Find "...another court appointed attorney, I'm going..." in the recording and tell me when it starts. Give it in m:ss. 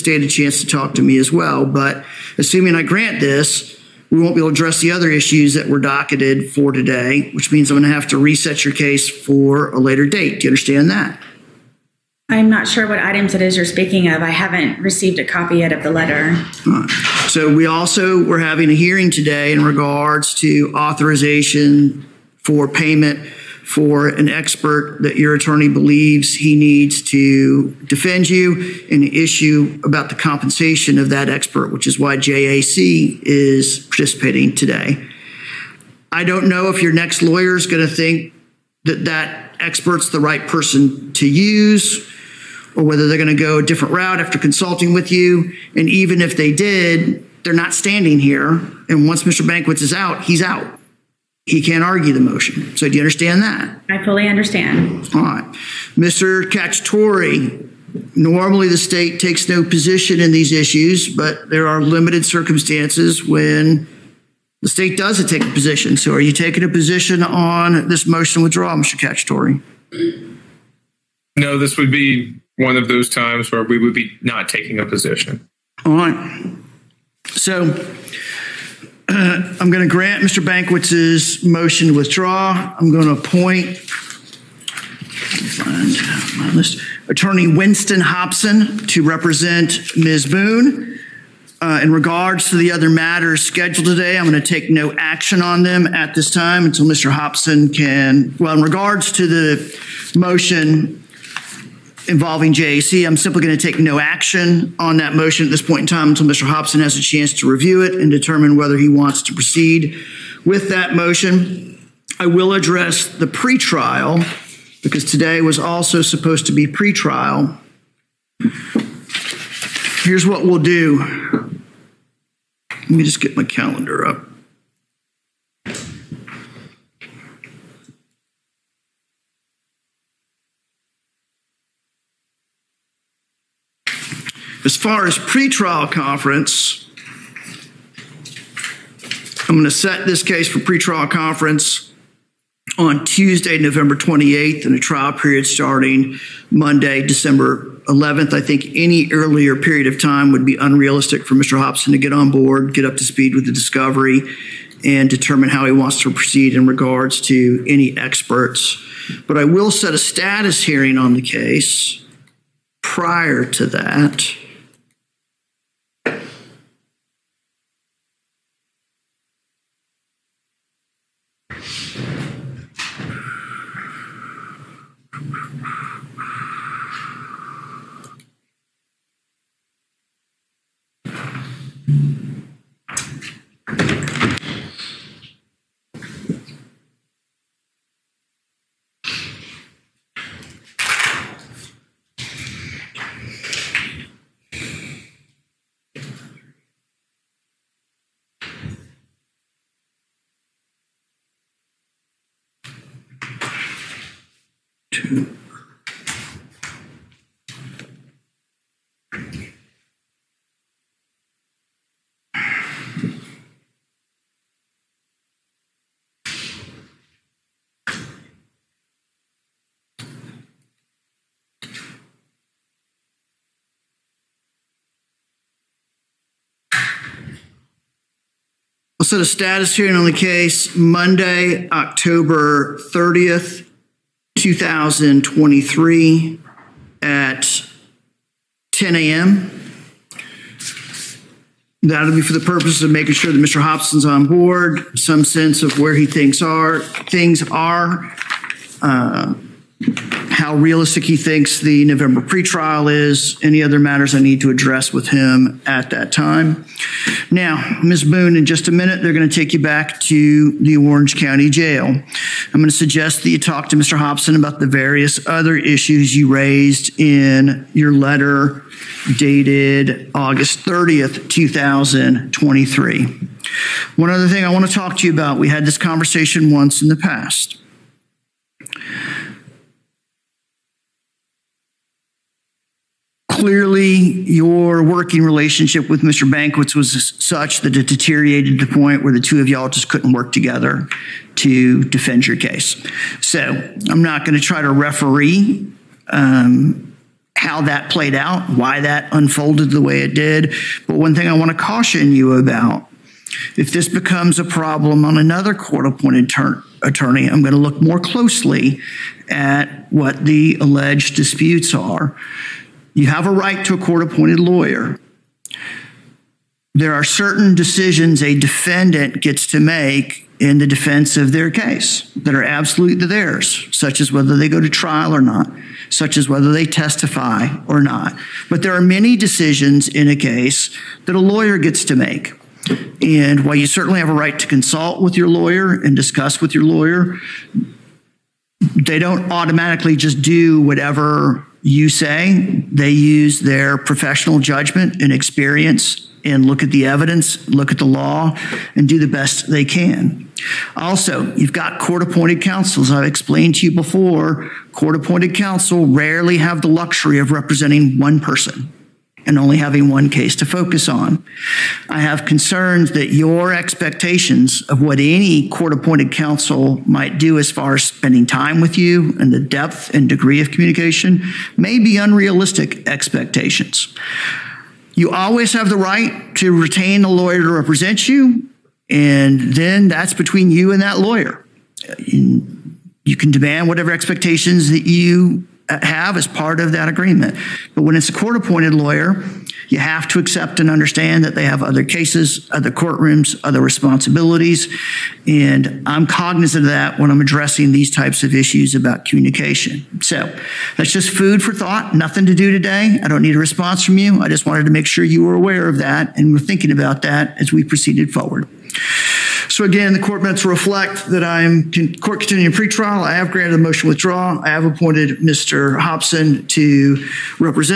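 5:05.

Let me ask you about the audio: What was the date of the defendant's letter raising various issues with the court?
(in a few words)
August 30th, 2023.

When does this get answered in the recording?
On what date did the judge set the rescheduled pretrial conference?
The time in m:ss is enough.
2:23.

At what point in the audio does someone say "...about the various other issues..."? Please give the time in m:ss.
4:24.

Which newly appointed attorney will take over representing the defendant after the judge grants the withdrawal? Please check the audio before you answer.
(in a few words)
Winston Hobson.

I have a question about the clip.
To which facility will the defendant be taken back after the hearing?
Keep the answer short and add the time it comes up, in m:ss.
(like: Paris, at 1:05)
Orange County Jail, at 4:20.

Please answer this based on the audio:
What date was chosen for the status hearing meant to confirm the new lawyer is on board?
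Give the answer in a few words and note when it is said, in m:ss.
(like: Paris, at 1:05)
Monday, October 30th, 2023, at 3:50.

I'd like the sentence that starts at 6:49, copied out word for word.
So again, the court minutes reflect that I am con court continuing pretrial.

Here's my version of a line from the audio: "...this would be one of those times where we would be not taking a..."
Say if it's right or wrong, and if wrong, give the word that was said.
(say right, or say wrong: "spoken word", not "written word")
right.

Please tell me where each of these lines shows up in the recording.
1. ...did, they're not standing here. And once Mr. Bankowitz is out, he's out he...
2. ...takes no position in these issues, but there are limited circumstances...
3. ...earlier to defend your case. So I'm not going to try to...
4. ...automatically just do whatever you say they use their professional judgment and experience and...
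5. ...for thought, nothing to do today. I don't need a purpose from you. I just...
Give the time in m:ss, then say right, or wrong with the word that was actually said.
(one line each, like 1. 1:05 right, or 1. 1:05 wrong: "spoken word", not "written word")
1. 0:46 right
2. 0:59 right
3. 4:50 wrong: "together", not "earlier"
4. 5:39 right
5. 6:41 wrong: "response", not "purpose".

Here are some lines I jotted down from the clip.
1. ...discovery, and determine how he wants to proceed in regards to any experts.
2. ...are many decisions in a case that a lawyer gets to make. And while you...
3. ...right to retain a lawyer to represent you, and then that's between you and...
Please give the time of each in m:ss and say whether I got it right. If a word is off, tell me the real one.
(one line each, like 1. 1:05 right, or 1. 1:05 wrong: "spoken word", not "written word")
1. 2:33 right
2. 5:28 right
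3. 6:15 right.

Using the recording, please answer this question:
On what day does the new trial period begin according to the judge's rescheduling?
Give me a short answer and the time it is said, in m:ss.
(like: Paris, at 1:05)
Monday, December 11th, at 2:26.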